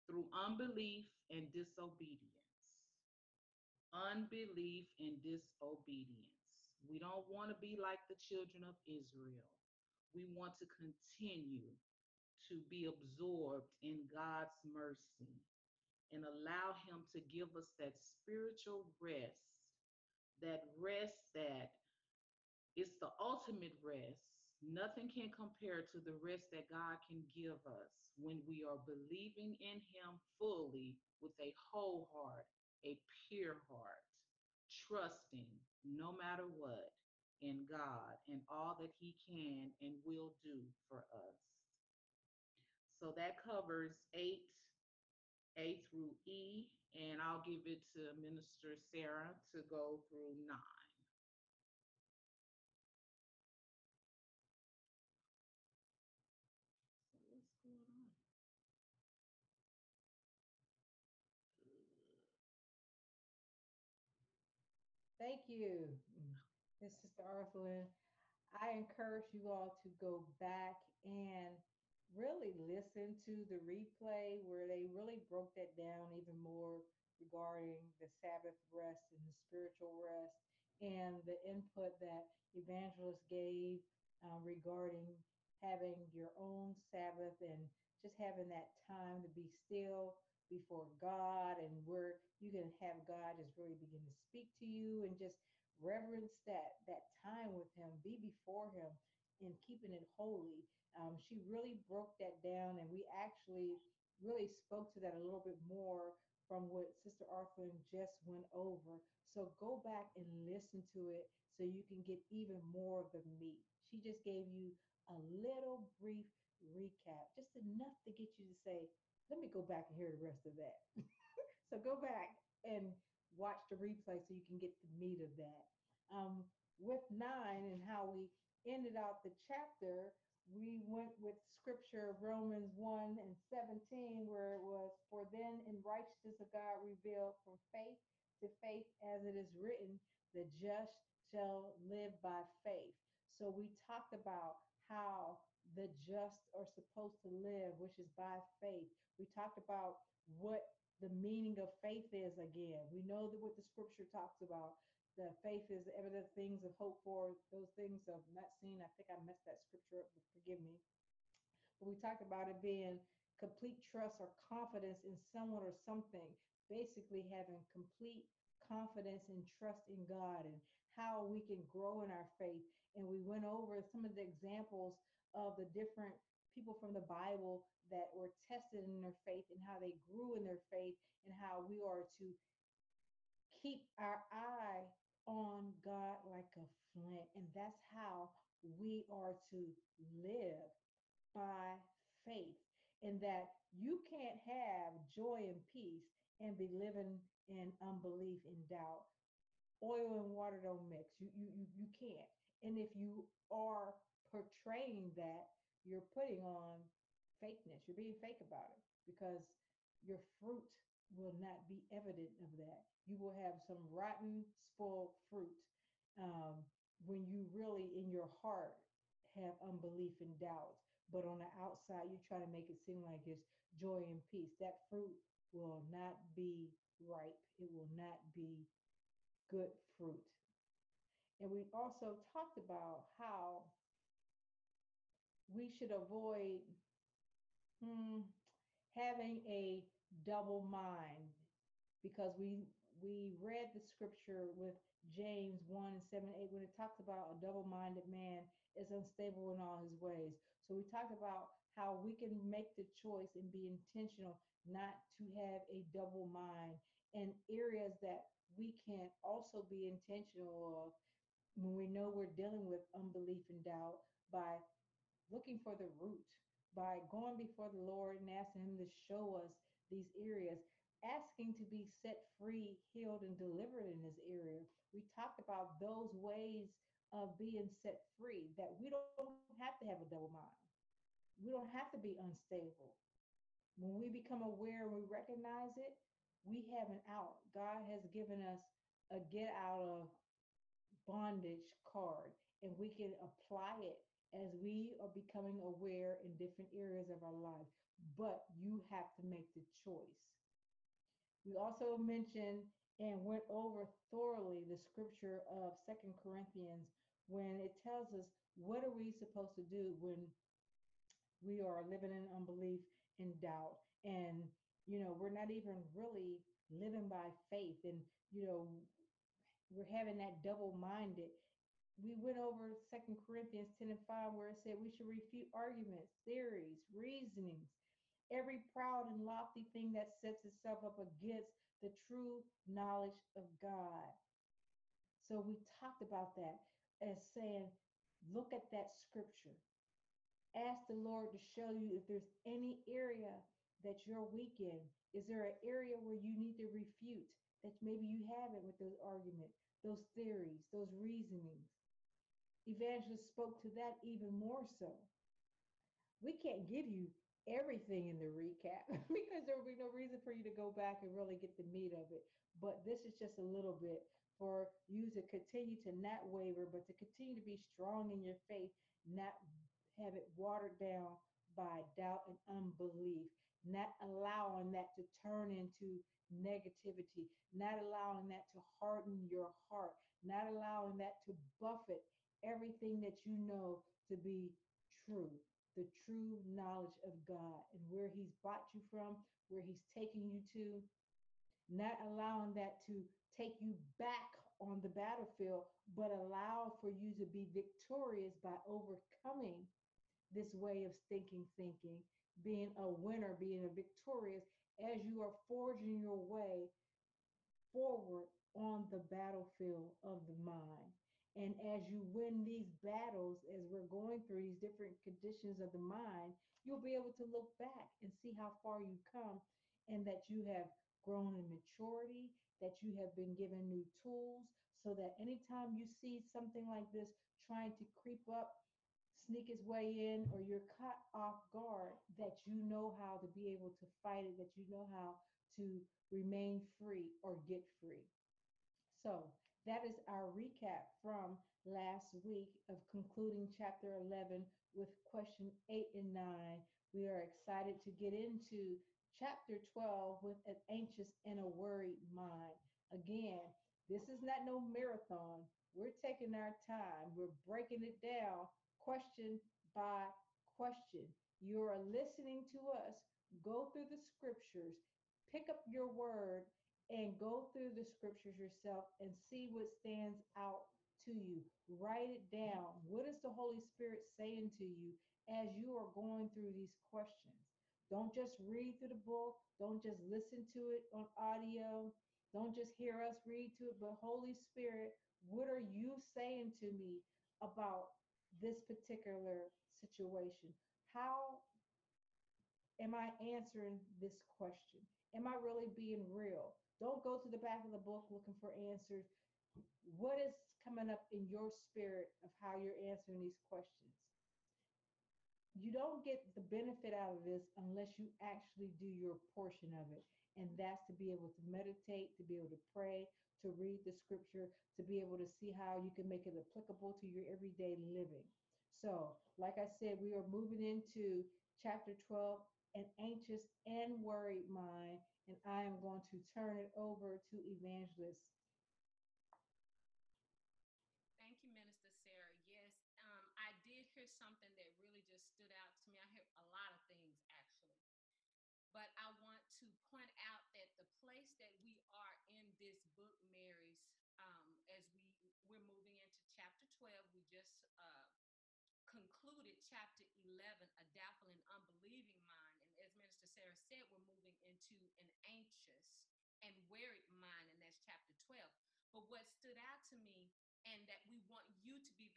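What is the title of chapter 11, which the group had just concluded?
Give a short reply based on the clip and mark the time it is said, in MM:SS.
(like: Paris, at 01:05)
A doubtful and unbelieving mind, at 09:10.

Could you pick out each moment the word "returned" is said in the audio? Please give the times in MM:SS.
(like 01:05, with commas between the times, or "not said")
not said.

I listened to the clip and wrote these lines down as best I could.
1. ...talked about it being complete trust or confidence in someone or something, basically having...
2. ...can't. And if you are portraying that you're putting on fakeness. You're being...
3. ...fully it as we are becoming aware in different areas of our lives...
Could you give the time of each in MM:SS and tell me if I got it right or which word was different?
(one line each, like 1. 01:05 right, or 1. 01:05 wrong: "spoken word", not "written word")
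1. 02:41 right
2. 03:21 right
3. 04:53 wrong: "apply", not "fully".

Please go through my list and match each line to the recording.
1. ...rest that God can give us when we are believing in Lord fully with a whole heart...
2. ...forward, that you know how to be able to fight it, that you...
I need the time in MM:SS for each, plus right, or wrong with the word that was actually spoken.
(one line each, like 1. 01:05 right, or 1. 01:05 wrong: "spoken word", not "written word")
1. 00:26 wrong: "Him", not "Lord"
2. 07:11 wrong: "guard", not "forward".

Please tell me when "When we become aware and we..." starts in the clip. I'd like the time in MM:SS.
04:43.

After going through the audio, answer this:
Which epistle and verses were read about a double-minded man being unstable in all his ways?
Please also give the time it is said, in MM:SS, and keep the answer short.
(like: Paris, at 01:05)
James 1:7-8, at 04:05.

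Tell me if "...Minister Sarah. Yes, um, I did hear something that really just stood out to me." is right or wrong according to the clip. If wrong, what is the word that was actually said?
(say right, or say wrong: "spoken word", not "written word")
right.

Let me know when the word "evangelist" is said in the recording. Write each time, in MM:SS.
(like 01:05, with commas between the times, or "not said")
01:22, 05:52, 08:47.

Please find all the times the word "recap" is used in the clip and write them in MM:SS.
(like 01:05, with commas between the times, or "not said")
01:56, 05:58, 07:20.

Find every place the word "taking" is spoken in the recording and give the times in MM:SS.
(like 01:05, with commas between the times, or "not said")
06:29, 07:35.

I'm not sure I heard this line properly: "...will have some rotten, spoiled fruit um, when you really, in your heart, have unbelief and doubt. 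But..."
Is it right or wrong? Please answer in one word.
right.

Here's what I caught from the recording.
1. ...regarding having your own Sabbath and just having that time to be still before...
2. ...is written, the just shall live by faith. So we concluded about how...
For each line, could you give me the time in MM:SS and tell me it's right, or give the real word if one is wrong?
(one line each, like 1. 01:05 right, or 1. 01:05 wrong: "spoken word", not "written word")
1. 01:24 right
2. 02:19 wrong: "talked", not "concluded".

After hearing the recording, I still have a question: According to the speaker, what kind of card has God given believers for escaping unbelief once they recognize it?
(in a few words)
Get out of bondage card.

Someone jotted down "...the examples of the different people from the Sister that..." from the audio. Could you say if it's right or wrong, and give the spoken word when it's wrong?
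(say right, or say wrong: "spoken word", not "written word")
wrong: "Bible", not "Sister".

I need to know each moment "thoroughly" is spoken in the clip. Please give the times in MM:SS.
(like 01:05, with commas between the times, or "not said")
05:04.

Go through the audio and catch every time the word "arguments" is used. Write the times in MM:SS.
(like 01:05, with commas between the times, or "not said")
05:25, 05:49.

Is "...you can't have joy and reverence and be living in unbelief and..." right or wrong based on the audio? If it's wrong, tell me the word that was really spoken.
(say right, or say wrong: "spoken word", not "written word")
wrong: "peace", not "reverence".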